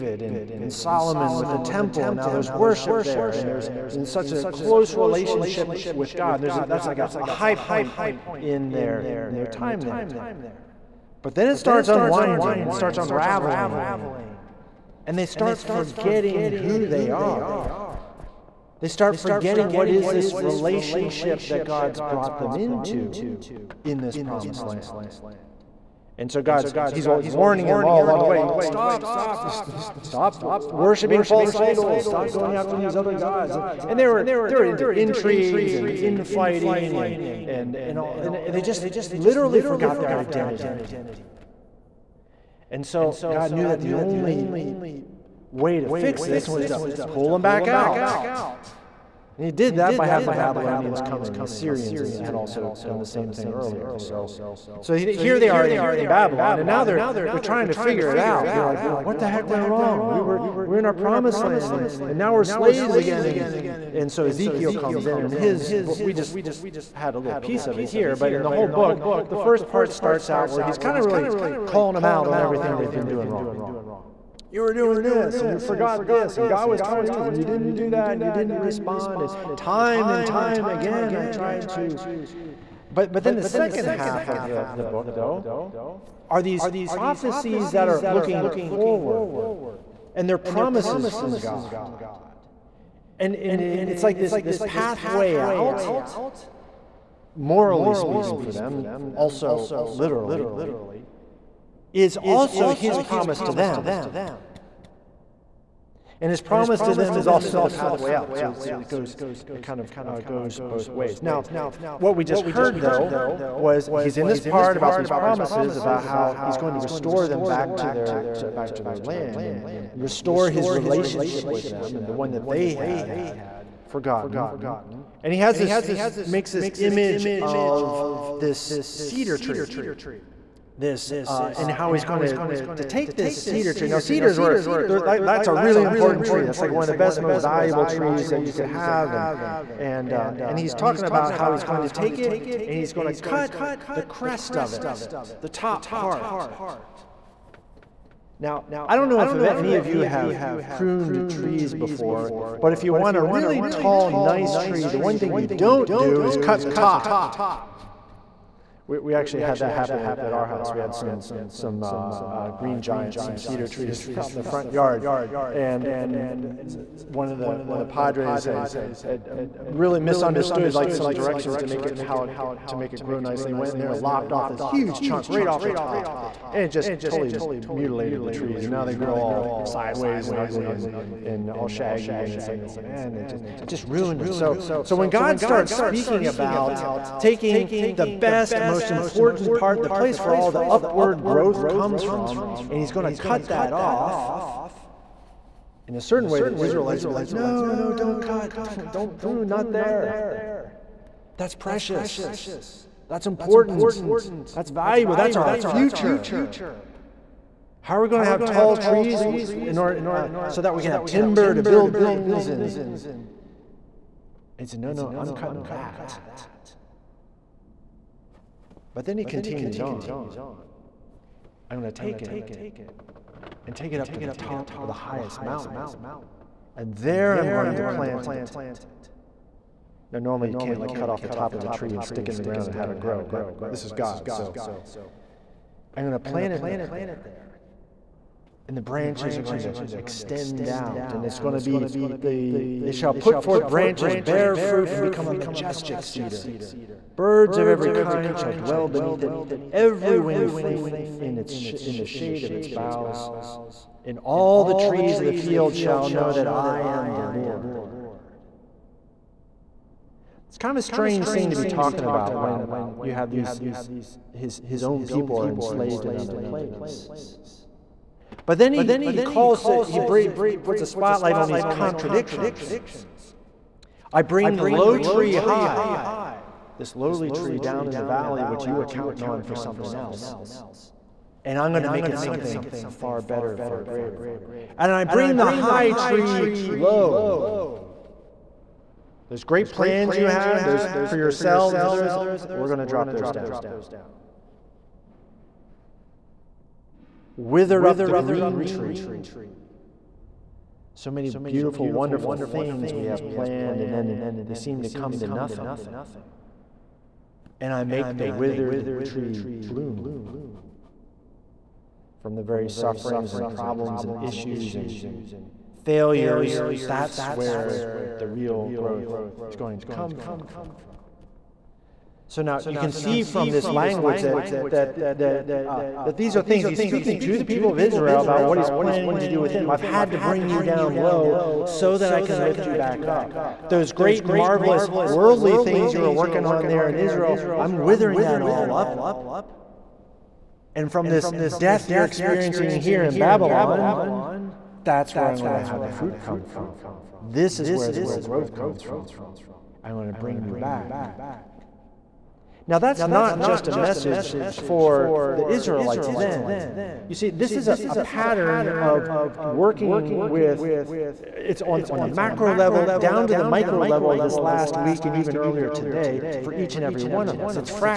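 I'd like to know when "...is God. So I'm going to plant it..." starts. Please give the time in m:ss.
3:53.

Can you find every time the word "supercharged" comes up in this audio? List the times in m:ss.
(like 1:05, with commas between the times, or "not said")
not said.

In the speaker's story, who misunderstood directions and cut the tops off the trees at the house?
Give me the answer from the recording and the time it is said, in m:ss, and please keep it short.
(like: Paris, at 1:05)
One of the Padres, at 2:47.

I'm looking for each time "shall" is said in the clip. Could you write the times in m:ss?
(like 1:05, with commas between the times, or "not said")
4:02, 4:08, 4:15.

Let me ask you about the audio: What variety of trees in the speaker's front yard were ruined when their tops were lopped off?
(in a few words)
Green giants.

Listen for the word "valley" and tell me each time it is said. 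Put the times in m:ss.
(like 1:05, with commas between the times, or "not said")
4:38.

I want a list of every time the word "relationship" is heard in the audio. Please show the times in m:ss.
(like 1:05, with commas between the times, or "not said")
0:04, 0:20, 2:00.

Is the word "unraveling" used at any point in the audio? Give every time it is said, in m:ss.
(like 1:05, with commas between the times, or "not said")
0:12.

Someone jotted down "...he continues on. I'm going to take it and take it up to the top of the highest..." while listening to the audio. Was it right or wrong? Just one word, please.
right.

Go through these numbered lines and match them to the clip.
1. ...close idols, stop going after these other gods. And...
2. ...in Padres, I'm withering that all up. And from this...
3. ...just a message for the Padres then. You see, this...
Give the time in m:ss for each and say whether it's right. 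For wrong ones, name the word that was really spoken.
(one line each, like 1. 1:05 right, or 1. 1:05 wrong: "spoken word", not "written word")
1. 0:31 wrong: "false", not "close"
2. 5:36 wrong: "Israel", not "Padres"
3. 5:53 wrong: "Israelites", not "Padres".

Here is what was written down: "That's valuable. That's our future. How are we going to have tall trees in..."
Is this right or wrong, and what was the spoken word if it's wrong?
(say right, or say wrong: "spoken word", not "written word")
right.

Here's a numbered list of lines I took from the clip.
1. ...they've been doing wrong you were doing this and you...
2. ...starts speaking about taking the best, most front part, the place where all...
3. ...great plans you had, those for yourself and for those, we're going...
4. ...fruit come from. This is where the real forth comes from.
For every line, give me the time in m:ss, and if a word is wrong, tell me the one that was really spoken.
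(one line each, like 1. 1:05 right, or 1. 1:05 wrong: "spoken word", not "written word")
1. 1:12 right
2. 3:05 wrong: "important", not "front"
3. 4:49 right
4. 5:45 wrong: "growth", not "forth".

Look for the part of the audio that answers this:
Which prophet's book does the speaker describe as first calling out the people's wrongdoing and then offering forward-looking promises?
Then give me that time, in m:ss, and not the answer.
1:04.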